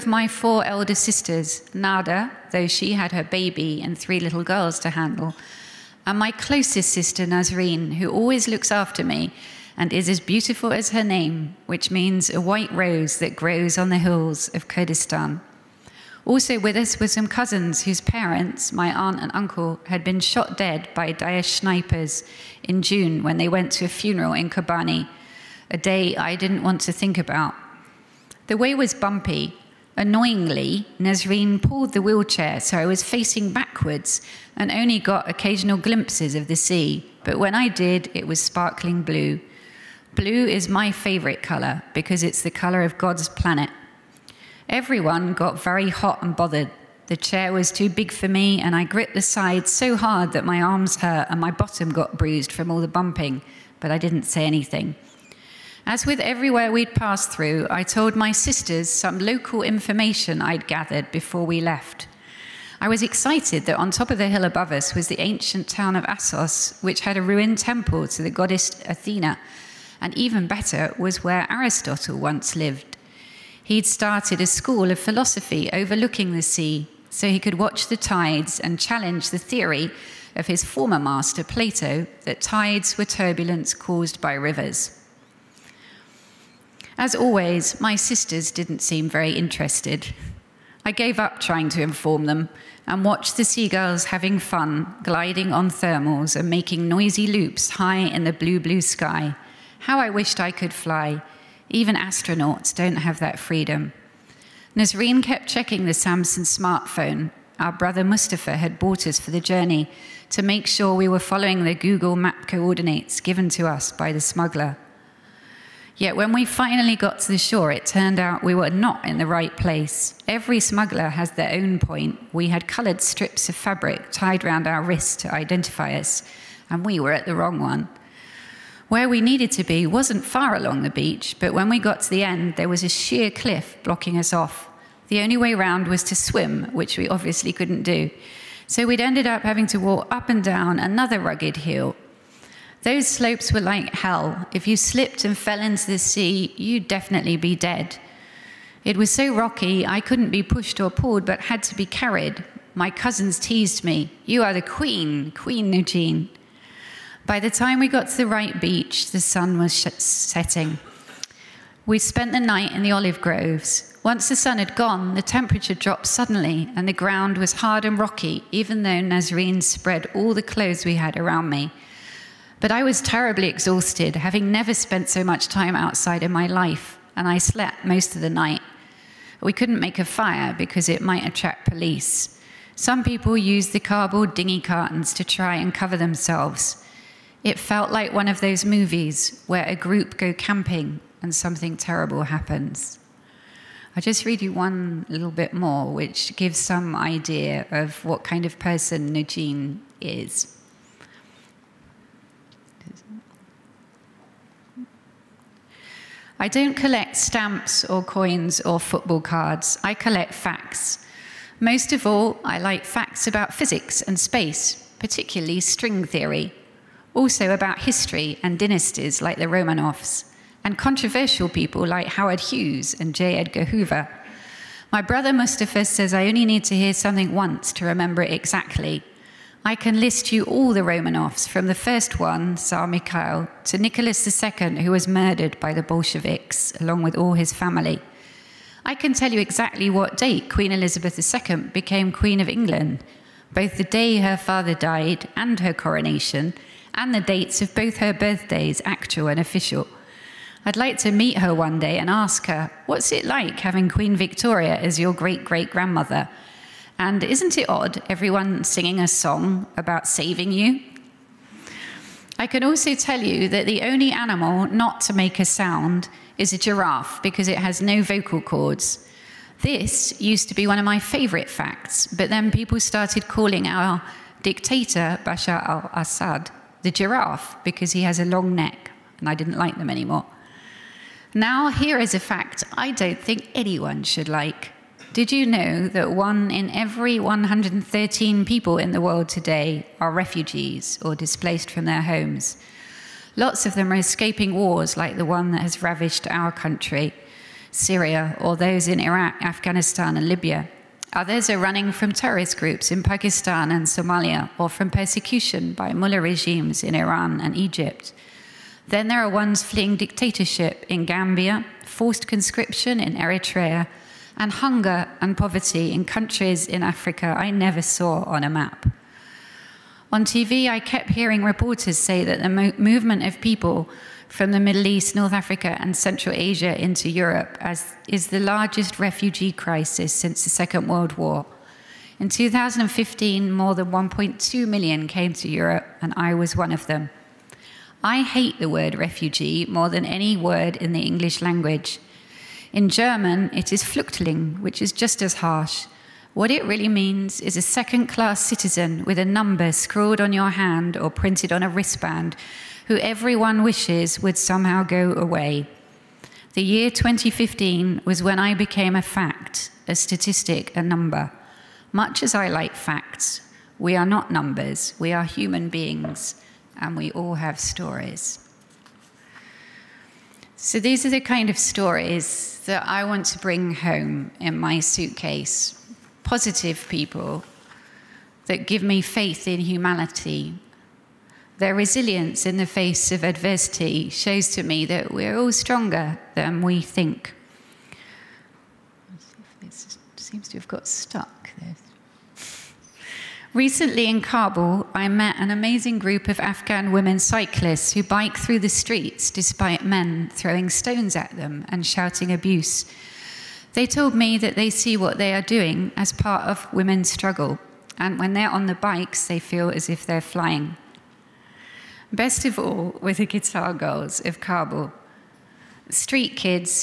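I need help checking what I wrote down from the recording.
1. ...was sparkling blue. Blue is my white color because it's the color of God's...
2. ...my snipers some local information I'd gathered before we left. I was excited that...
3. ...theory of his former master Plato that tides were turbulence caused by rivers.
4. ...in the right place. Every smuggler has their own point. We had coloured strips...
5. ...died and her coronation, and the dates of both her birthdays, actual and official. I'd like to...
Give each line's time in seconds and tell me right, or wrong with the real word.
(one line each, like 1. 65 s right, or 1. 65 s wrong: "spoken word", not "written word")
1. 38 s wrong: "favorite", not "white"
2. 58 s wrong: "sisters", not "snipers"
3. 79 s right
4. 119 s right
5. 244 s right.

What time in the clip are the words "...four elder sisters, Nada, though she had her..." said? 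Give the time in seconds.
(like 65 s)
0 s.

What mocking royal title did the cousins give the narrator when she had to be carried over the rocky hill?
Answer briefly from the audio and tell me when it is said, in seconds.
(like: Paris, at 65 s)
Queen Nujeen, at 155 s.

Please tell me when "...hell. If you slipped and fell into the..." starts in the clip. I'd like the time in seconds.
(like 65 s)
143 s.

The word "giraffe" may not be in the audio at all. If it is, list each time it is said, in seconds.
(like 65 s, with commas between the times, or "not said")
266 s, 276 s.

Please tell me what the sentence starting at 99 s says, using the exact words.
How I wished I could fly.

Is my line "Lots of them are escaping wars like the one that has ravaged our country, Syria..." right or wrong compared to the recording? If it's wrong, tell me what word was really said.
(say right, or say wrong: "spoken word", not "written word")
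right.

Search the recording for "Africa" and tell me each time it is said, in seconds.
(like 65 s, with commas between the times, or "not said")
316 s, 325 s.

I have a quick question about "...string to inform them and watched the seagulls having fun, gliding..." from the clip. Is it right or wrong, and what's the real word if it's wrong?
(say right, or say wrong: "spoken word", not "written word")
wrong: "trying", not "string".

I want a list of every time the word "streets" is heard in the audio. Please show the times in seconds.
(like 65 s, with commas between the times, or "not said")
398 s, 415 s.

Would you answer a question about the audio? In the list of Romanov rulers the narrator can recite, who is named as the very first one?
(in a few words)
Tsar Mikhail.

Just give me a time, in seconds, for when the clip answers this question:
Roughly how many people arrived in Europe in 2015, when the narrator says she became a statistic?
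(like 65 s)
333 s.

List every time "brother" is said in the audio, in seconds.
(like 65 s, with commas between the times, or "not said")
107 s, 225 s.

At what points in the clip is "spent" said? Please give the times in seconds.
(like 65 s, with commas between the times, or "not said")
161 s, 174 s.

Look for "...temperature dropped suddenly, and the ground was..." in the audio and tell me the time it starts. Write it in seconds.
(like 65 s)
165 s.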